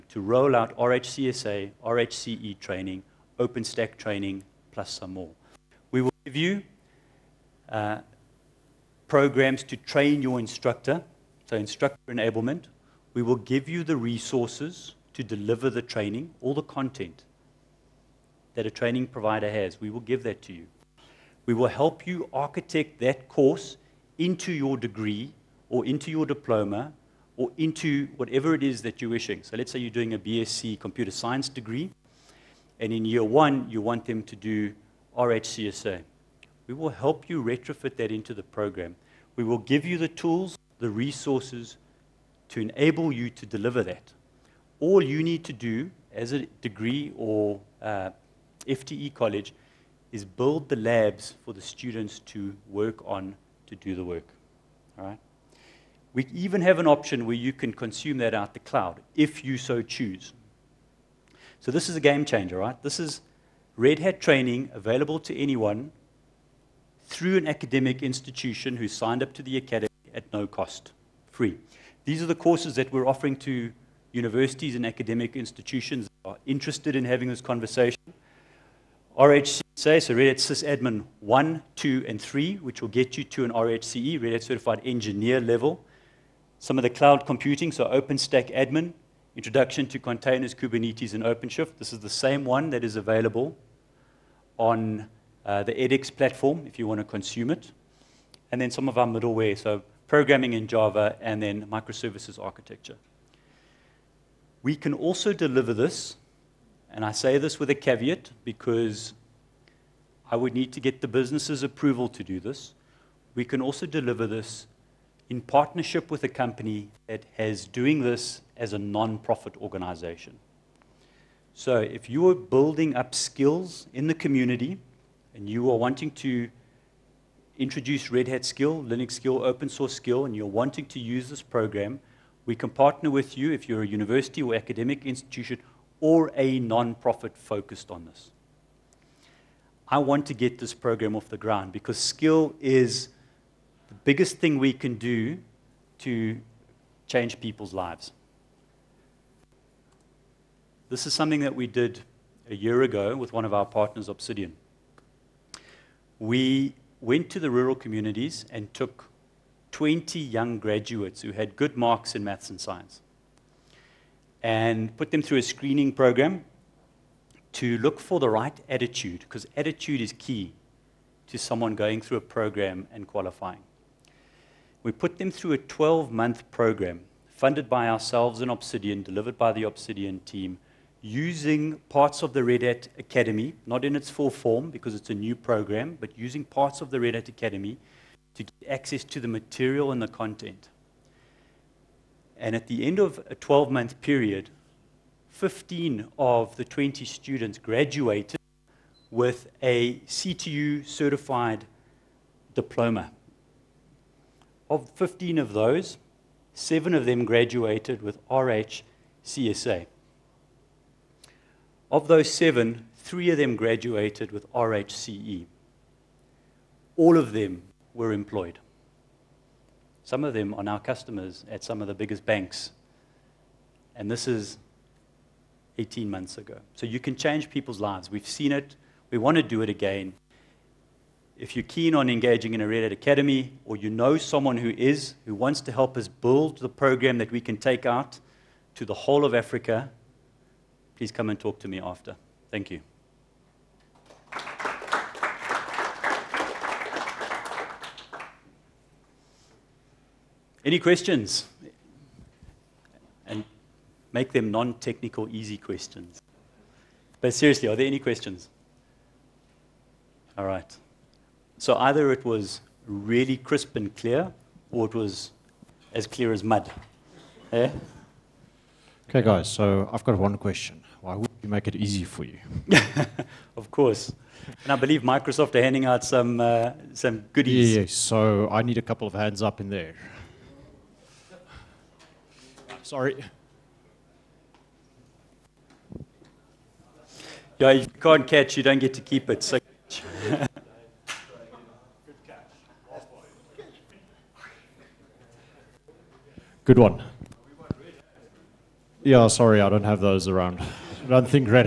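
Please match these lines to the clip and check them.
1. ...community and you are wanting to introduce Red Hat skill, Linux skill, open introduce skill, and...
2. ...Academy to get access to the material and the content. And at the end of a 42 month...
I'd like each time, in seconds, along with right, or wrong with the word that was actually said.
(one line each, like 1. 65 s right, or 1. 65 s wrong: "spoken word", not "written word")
1. 124 s wrong: "source", not "introduce"
2. 187 s wrong: "12", not "42".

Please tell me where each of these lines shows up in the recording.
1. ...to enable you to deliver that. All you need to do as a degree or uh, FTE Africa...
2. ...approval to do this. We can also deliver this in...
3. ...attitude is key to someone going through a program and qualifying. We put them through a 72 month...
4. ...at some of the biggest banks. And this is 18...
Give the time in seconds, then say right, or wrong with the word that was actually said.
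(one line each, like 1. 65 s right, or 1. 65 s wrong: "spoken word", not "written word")
1. 42 s wrong: "College", not "Africa"
2. 111 s right
3. 169 s wrong: "12", not "72"
4. 221 s right.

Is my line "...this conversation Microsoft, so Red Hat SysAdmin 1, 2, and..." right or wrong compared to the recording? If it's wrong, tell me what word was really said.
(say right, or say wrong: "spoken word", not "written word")
wrong: "RHCSA", not "Microsoft".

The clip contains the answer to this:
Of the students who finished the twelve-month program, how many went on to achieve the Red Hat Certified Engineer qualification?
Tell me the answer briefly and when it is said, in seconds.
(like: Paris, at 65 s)
3, at 212 s.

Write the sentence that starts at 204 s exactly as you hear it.
Of 15 of those, seven of them graduated with RH CSA.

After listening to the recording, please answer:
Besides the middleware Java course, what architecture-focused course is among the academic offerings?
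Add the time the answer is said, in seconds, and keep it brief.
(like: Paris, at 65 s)
Microservices architecture, at 101 s.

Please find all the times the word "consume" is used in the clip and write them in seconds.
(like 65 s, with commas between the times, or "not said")
57 s, 97 s.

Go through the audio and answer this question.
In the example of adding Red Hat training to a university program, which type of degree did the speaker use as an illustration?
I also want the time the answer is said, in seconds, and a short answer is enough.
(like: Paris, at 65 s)
BSc computer science, at 30 s.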